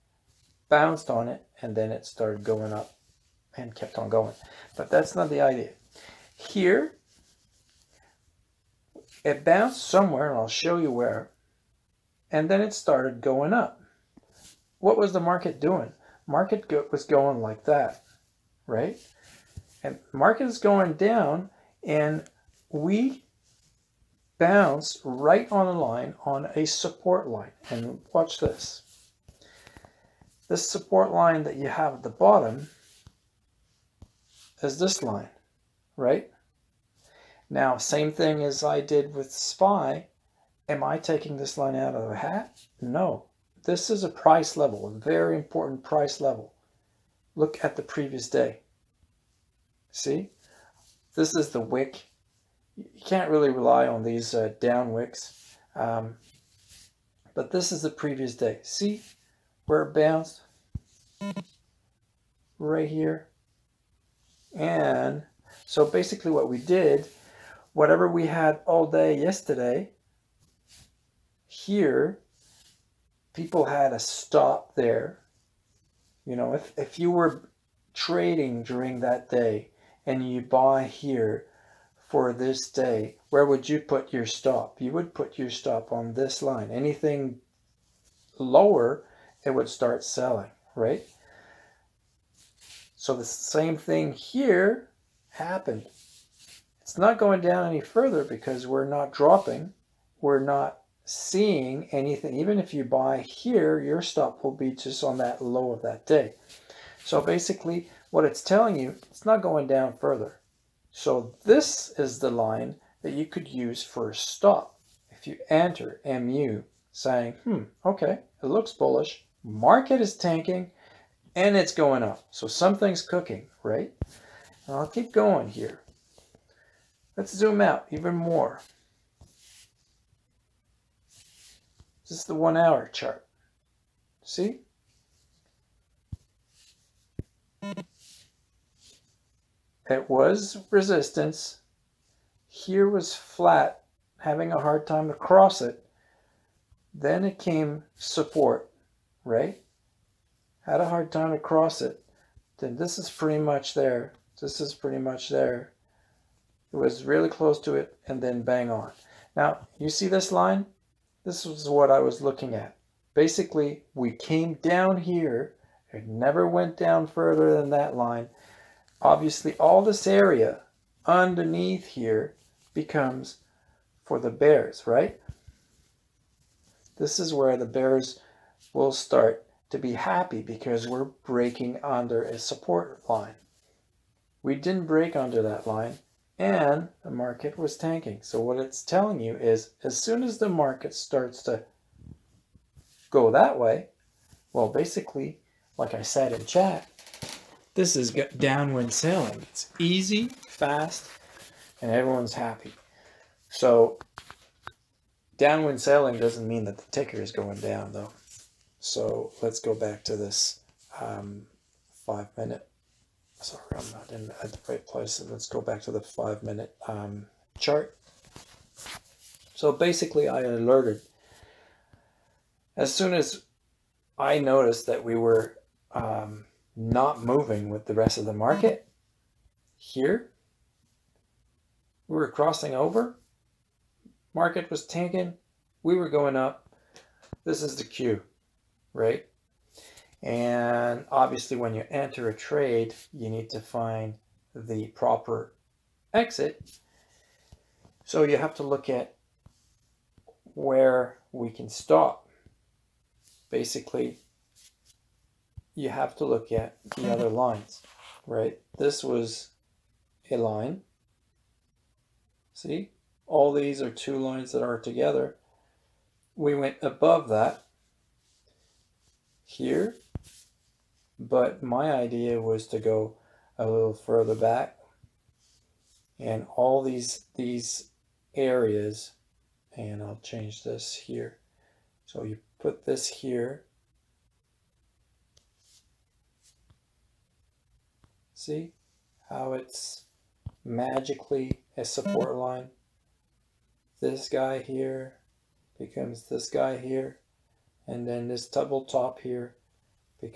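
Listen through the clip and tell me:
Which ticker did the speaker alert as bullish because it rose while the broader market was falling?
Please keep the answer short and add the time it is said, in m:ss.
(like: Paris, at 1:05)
MU, at 1:56.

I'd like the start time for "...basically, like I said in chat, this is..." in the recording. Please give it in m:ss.
3:14.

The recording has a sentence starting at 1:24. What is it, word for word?
You would put your stop on this line.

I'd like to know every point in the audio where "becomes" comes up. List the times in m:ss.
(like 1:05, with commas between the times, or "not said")
2:52, 4:55.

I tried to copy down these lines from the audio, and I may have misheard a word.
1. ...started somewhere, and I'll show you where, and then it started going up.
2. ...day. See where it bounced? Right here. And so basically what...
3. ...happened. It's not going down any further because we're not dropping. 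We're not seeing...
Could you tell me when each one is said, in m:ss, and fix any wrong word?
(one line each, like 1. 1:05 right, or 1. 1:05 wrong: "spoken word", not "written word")
1. 0:09 wrong: "bounced", not "started"
2. 0:58 right
3. 1:35 right.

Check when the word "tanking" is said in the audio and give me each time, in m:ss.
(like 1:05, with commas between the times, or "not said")
2:00, 3:07, 3:54.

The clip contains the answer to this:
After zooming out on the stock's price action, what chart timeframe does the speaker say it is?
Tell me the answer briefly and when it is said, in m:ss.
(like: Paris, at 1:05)
One hour, at 2:12.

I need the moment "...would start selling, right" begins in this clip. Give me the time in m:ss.
1:29.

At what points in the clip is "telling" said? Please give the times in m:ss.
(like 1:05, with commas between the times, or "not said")
1:48, 3:08.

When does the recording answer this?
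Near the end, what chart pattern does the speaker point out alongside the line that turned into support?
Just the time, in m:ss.
4:58.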